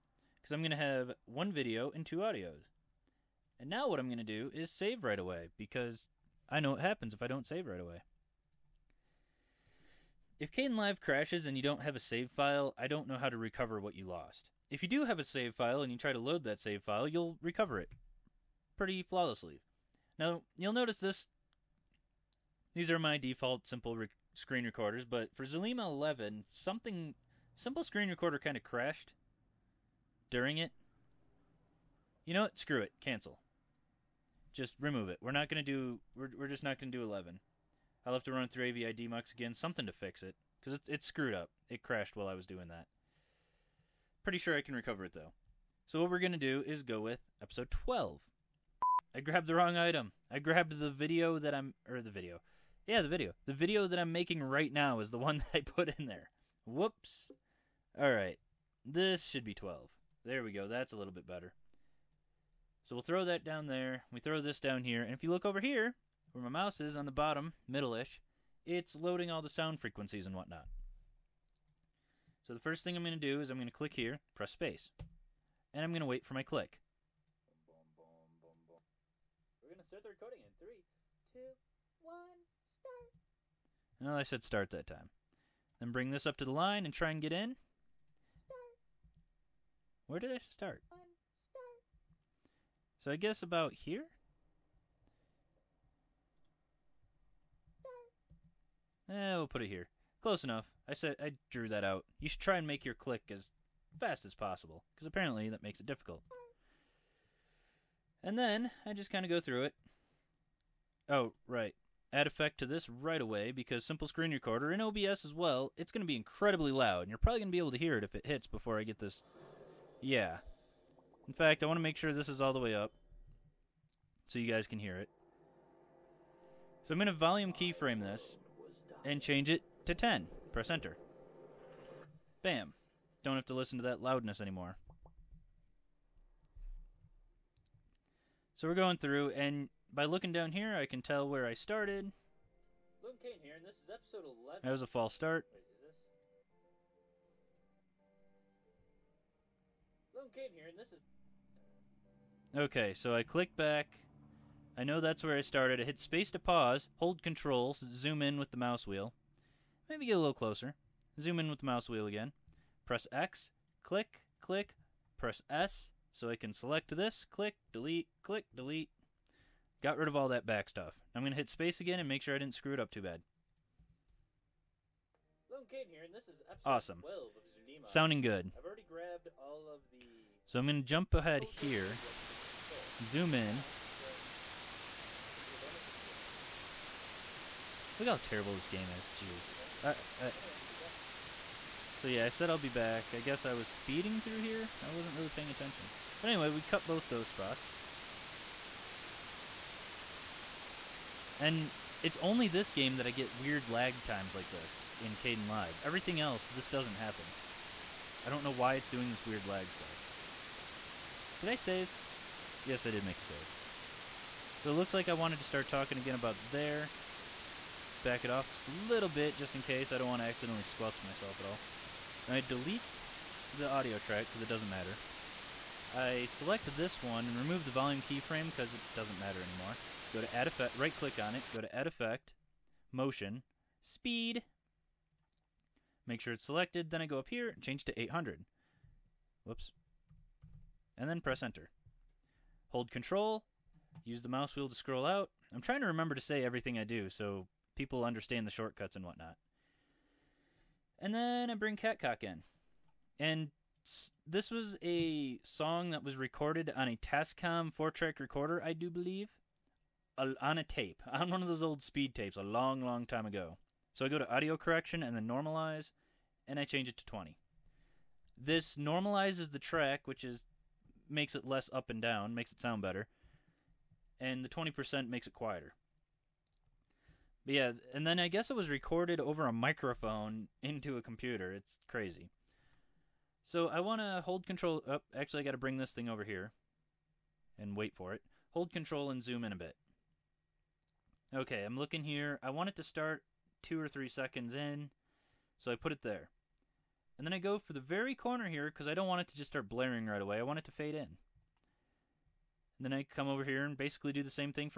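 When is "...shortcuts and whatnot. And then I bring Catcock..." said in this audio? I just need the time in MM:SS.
04:08.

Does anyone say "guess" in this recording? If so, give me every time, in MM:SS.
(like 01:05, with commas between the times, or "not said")
01:33, 03:13, 04:38.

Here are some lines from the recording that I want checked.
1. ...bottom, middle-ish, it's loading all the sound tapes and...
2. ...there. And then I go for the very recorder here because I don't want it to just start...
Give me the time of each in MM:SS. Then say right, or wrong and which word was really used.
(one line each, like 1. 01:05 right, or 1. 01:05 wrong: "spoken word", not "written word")
1. 01:07 wrong: "frequencies", not "tapes"
2. 04:56 wrong: "corner", not "recorder".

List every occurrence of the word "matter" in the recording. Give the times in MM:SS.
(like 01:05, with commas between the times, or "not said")
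03:44, 03:49.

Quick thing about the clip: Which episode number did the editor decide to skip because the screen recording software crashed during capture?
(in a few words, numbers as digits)
11.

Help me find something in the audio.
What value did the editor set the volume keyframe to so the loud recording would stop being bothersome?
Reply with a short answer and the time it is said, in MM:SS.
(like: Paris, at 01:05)
10, at 02:09.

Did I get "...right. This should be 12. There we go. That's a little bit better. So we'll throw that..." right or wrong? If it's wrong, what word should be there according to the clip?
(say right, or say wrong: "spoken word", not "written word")
right.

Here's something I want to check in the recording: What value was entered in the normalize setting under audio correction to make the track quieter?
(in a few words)
20.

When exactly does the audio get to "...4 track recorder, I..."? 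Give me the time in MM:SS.
04:17.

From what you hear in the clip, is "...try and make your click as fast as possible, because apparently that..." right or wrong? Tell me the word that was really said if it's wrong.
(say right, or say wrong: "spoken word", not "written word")
right.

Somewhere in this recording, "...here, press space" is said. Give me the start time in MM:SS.
01:13.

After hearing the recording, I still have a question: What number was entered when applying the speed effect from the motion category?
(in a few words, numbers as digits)
800.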